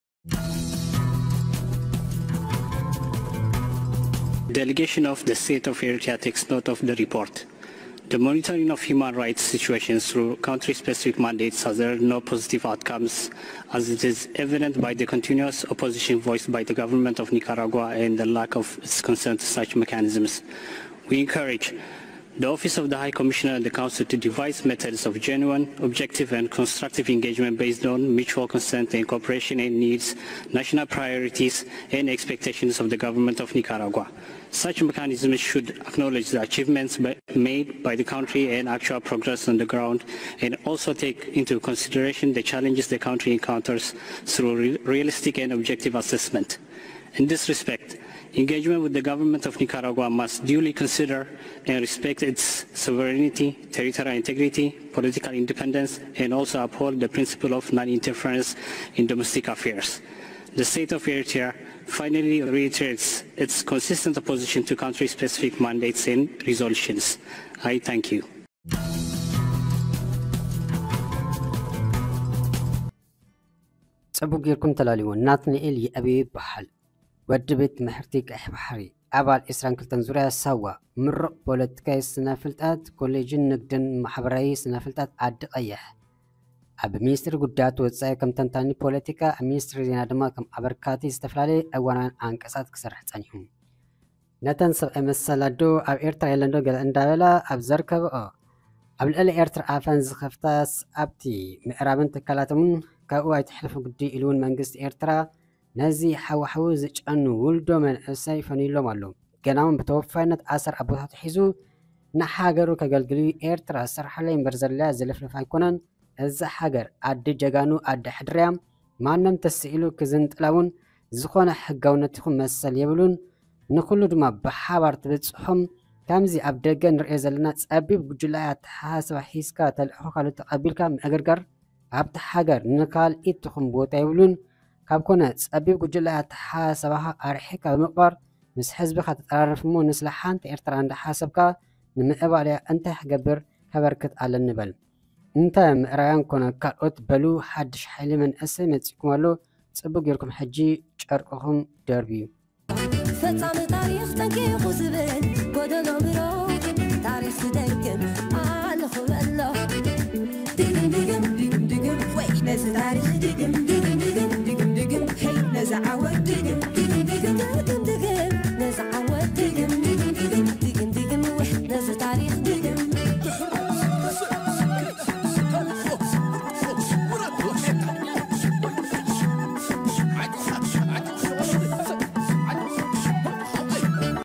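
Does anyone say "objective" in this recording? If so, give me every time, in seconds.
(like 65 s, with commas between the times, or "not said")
25 s, 45 s.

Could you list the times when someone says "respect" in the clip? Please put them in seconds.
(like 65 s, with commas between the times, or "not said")
47 s, 51 s.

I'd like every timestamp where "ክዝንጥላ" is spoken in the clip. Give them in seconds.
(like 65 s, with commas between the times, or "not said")
119 s.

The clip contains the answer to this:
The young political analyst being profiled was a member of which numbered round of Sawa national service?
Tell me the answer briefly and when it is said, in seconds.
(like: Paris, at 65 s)
22, at 79 s.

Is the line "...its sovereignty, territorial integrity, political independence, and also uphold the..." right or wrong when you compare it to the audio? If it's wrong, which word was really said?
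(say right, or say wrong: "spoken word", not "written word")
right.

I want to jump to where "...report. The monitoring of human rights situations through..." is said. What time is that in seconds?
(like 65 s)
6 s.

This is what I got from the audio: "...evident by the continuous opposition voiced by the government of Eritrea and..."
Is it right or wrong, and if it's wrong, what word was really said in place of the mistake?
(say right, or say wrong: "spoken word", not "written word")
wrong: "Nicaragua", not "Eritrea".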